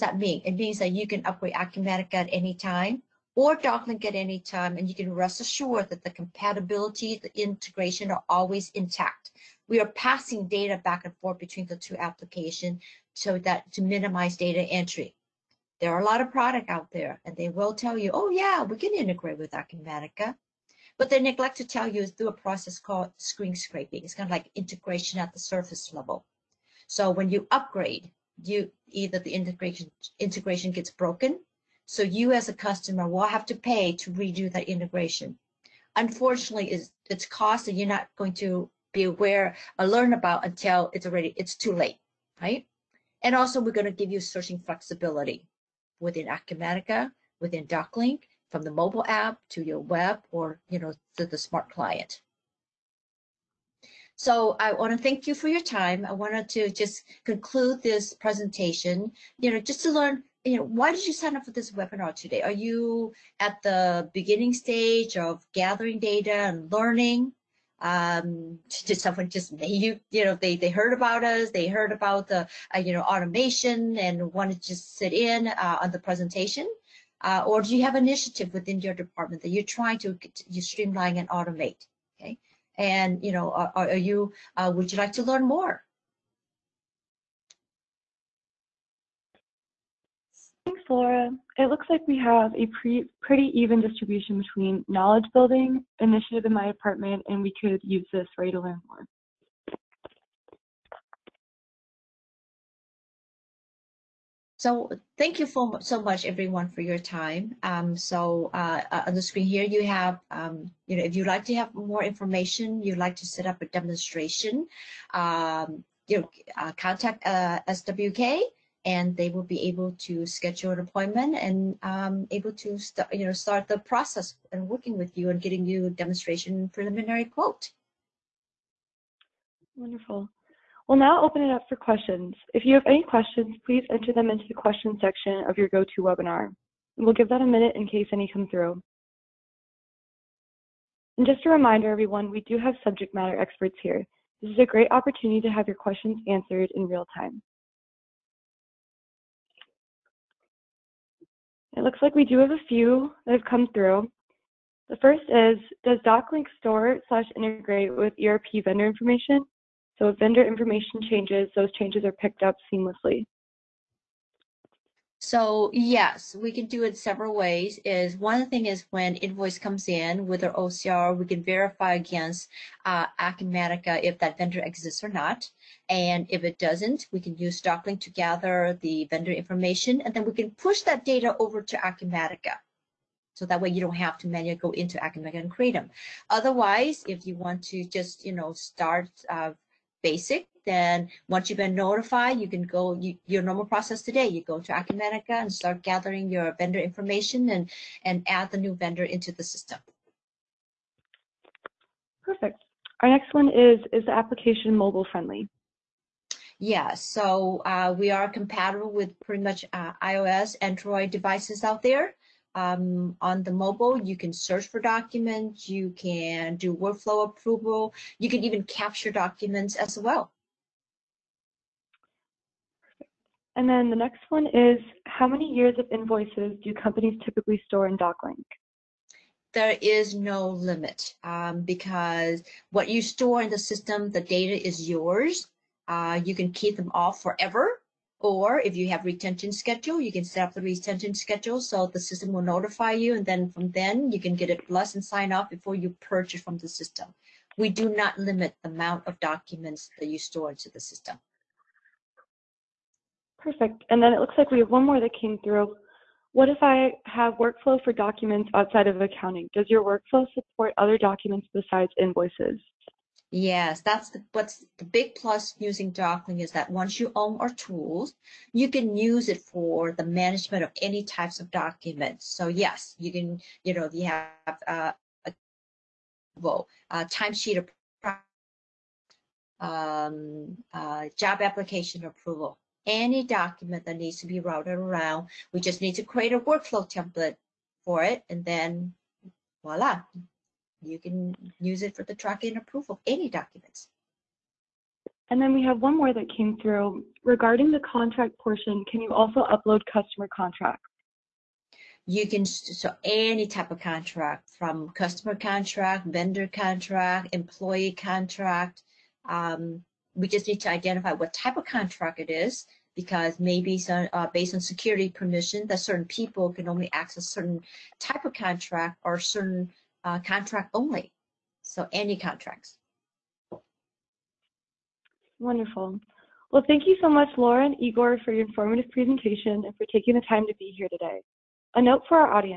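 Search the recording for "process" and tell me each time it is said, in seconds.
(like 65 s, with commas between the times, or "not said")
22 s, 123 s, 193 s.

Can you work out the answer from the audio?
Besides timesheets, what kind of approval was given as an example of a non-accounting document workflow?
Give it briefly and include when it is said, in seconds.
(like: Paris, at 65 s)
job application approval, at 281 s.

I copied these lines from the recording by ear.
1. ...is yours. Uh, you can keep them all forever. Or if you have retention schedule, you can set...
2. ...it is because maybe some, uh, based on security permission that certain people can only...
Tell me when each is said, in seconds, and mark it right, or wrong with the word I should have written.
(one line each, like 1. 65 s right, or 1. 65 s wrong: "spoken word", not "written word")
1. 234 s right
2. 312 s right.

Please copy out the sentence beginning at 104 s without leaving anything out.
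So thank you for, so much, everyone, for your time.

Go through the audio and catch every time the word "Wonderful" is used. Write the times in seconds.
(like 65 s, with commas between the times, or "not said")
129 s, 325 s.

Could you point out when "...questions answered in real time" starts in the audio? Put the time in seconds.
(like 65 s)
145 s.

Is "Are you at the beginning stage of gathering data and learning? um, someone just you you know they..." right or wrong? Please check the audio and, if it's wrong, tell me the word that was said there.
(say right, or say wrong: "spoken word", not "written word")
right.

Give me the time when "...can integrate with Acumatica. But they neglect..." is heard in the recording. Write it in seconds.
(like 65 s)
18 s.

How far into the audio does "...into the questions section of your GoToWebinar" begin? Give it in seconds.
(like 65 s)
134 s.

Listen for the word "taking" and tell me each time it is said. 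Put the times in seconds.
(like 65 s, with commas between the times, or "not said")
329 s.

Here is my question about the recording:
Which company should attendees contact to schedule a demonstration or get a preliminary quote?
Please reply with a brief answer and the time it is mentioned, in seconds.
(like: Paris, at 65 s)
SWK, at 117 s.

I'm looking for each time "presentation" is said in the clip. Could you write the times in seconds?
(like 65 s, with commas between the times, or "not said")
58 s, 75 s, 328 s.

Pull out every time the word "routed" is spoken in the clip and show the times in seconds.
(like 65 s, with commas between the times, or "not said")
284 s.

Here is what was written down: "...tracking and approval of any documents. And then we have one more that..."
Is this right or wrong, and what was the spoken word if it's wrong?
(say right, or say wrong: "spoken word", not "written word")
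right.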